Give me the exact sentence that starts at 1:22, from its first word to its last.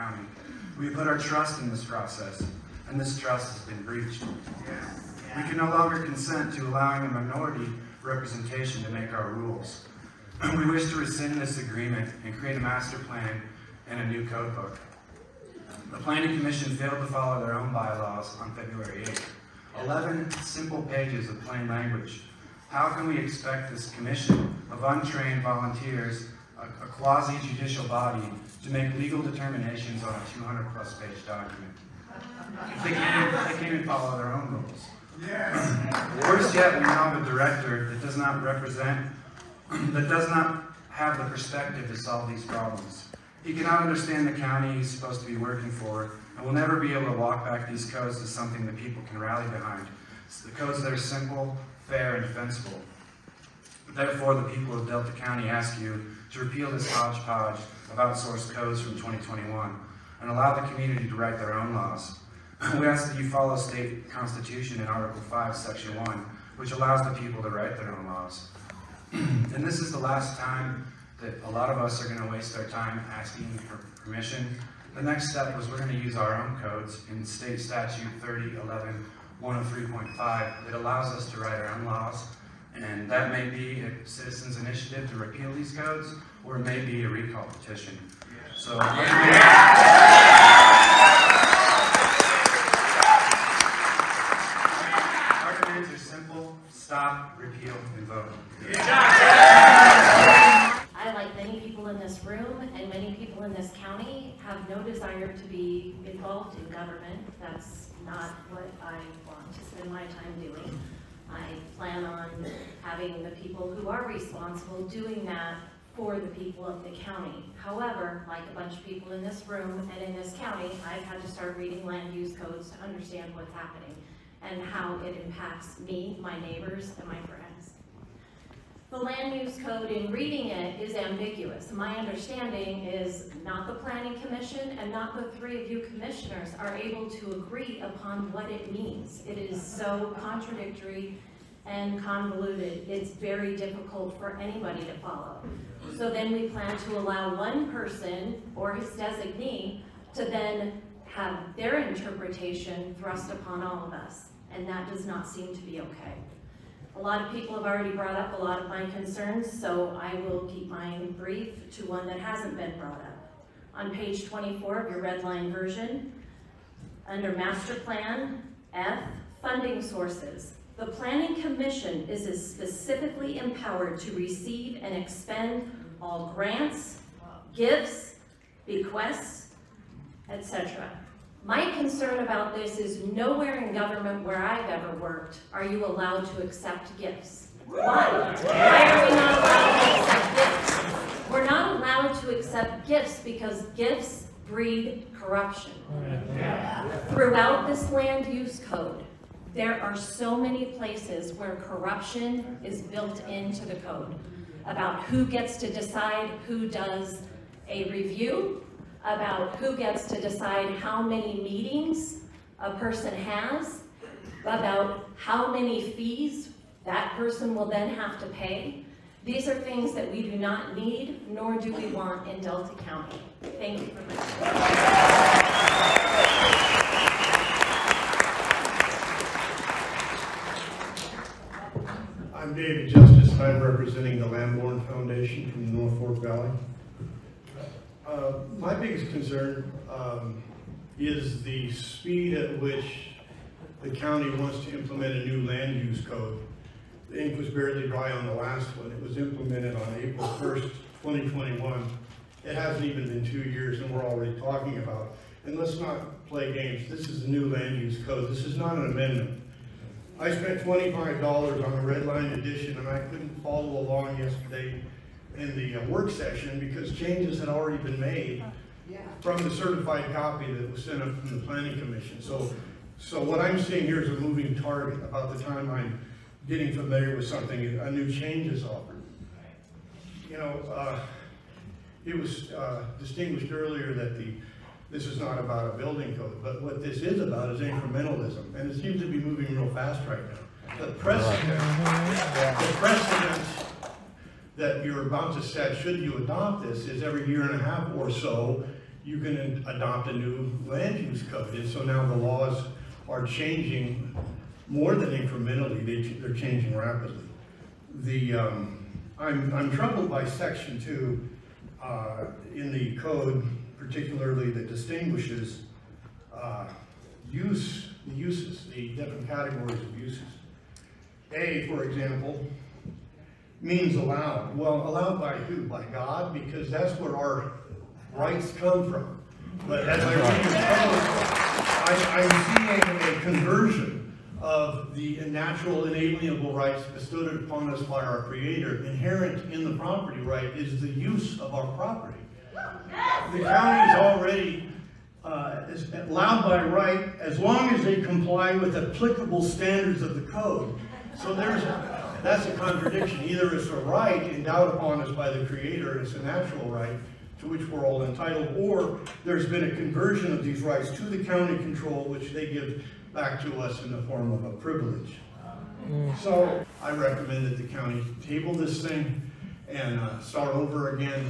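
And that may be a citizens initiative to repeal these codes, or it may be a recall petition.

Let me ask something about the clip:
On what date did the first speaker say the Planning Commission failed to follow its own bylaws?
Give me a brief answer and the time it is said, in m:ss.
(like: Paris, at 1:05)
February 8th, at 0:18.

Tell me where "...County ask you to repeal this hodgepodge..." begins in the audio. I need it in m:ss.
0:55.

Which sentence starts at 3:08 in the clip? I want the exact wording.
Why are we not allowed to accept gifts?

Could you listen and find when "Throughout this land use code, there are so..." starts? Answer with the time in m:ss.
3:17.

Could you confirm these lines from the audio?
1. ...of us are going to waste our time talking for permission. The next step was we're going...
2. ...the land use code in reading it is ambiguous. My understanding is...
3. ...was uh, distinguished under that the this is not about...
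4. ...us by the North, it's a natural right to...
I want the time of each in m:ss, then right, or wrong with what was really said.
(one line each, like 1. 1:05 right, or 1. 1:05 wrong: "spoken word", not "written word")
1. 1:11 wrong: "asking", not "talking"
2. 2:08 right
3. 4:42 wrong: "earlier", not "under"
4. 5:55 wrong: "Creator", not "North".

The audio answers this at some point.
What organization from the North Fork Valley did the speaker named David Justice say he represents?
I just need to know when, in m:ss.
3:54.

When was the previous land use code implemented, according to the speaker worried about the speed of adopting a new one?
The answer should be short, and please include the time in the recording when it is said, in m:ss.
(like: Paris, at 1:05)
April 1st, 2021, at 4:10.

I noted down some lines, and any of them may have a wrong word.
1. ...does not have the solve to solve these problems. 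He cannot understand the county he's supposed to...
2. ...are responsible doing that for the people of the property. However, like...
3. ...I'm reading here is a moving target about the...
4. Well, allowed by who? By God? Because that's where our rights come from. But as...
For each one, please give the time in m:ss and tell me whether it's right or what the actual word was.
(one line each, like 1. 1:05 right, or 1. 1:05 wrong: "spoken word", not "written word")
1. 0:40 wrong: "perspective", not "solve"
2. 1:53 wrong: "county", not "property"
3. 4:33 wrong: "seeing", not "reading"
4. 5:24 right.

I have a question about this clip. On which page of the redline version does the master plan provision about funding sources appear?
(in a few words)
Page 24.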